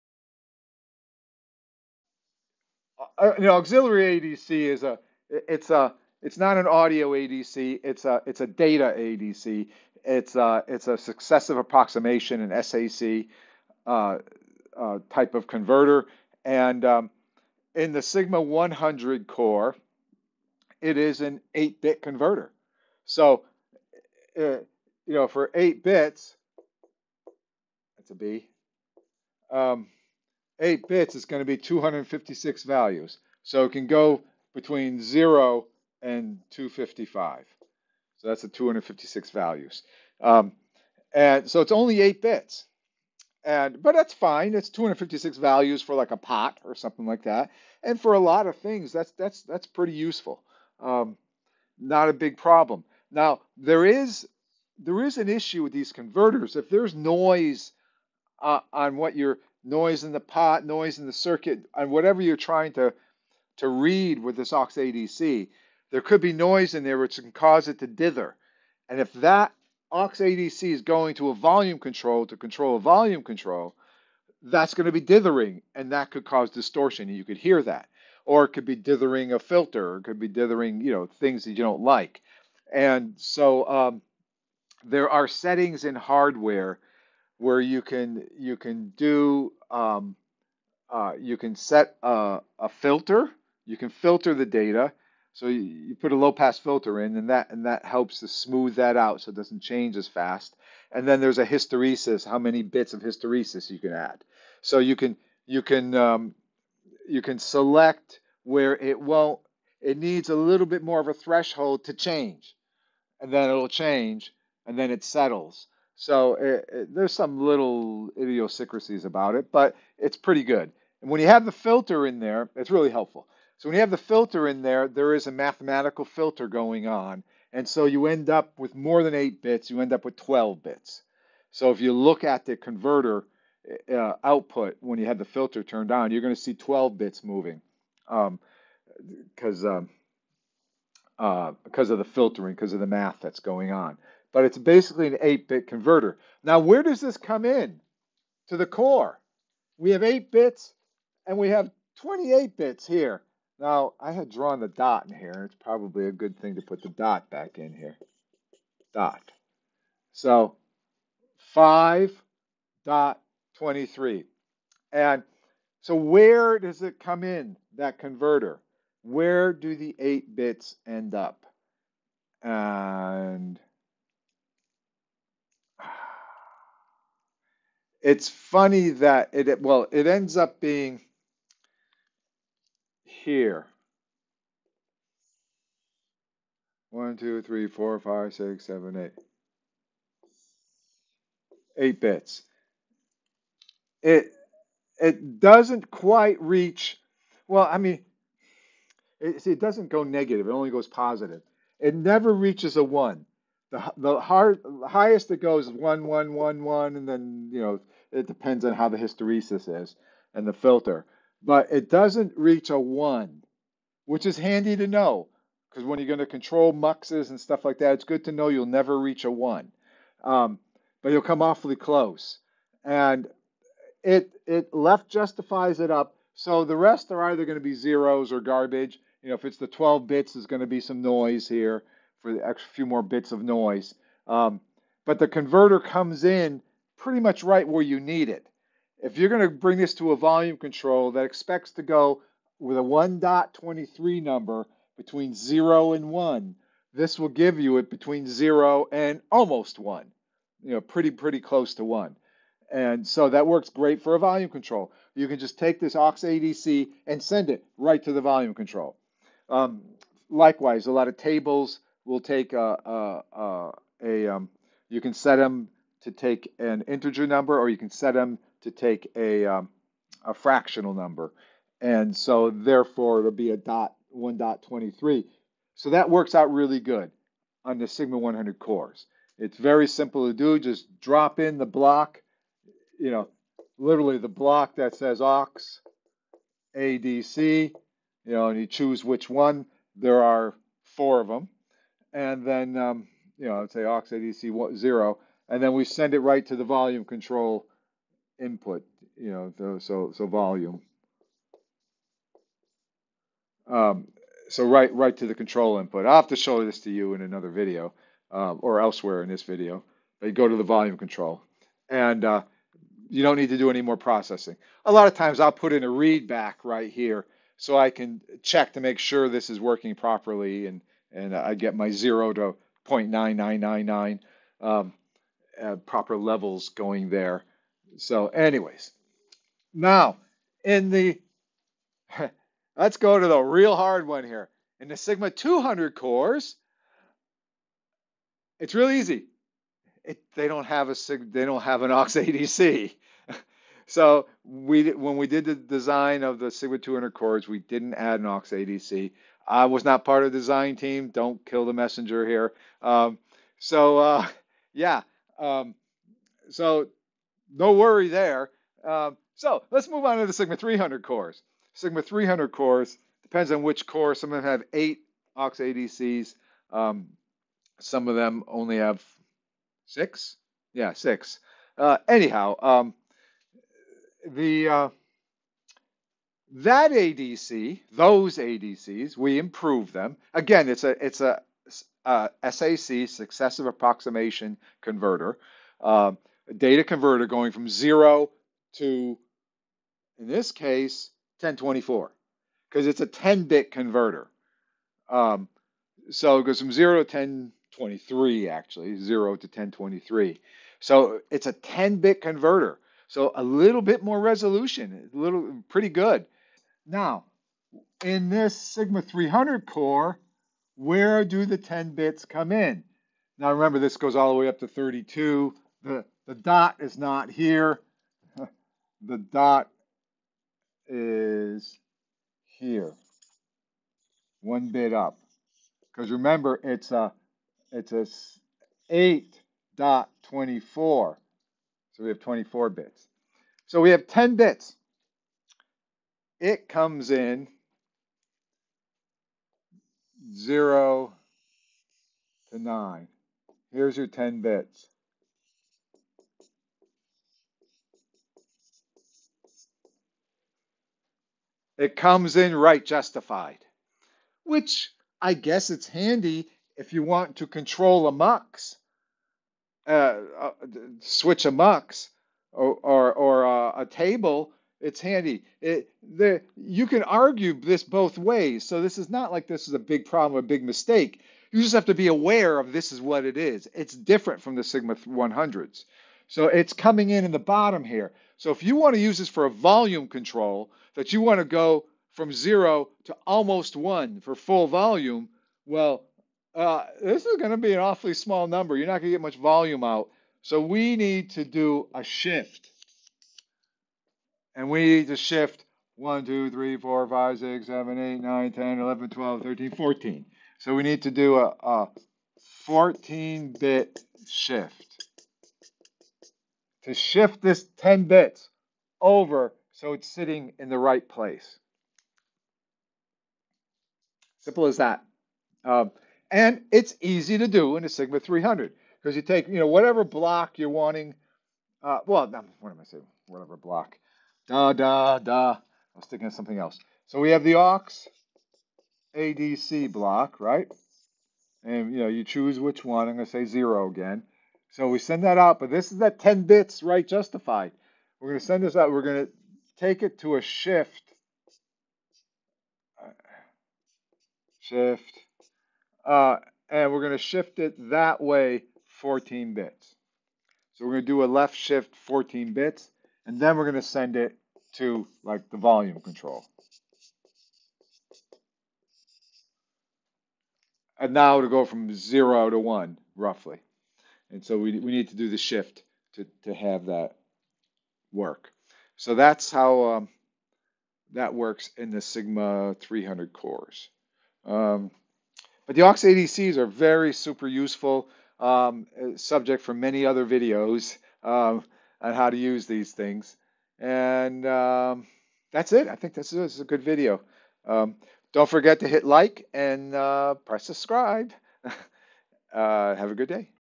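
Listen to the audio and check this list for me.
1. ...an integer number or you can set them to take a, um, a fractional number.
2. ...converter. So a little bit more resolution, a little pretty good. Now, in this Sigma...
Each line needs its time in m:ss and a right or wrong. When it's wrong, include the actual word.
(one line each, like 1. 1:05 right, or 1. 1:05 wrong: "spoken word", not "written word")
1. 4:26 right
2. 6:42 right.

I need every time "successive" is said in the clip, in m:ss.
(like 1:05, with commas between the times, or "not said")
0:10, 6:23.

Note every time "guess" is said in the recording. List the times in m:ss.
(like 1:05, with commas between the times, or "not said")
7:35.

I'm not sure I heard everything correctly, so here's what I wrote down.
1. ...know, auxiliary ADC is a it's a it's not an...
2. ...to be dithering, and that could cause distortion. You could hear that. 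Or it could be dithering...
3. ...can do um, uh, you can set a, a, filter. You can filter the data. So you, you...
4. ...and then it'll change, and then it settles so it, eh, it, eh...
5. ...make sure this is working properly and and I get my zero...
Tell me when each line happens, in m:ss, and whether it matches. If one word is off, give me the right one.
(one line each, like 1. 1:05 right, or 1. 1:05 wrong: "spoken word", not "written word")
1. 0:03 right
2. 1:14 right
3. 1:28 right
4. 1:53 right
5. 5:18 right.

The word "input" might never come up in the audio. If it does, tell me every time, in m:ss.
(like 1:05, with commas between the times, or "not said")
4:58, 5:05.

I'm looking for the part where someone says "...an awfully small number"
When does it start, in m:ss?
8:07.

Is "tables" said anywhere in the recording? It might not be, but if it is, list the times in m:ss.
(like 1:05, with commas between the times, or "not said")
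4:21, 7:43.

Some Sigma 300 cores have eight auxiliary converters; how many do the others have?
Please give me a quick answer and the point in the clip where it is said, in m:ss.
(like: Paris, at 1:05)
6, at 6:08.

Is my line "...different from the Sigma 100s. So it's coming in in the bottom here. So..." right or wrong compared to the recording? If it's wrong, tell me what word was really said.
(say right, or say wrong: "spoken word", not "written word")
right.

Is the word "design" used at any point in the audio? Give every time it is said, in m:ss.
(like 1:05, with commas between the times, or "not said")
5:45, 5:50.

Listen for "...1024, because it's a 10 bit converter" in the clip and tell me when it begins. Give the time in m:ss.
6:31.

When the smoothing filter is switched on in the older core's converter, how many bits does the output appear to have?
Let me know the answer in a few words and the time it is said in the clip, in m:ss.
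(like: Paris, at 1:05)
12 bits, at 2:09.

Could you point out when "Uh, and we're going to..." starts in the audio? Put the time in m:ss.
9:06.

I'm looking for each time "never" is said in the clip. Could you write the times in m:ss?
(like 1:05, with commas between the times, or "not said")
3:21, 3:38.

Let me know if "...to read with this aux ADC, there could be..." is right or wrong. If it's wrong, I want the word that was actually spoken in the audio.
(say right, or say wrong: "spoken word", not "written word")
right.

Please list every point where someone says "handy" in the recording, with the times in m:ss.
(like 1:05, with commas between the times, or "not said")
3:34, 7:35, 7:44.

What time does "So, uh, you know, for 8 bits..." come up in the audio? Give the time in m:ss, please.
0:23.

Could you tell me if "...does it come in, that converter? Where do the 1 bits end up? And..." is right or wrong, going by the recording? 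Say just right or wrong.
wrong.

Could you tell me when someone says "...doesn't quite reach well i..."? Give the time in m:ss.
3:15.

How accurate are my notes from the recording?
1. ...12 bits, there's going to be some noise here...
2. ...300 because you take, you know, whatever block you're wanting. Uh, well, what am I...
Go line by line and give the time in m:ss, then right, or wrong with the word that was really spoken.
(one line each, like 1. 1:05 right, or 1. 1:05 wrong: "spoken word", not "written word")
1. 3:49 right
2. 8:38 right.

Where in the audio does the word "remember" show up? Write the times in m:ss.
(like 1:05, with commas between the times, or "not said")
6:53, 7:06.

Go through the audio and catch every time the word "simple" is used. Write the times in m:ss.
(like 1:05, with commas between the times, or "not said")
4:39, 8:34.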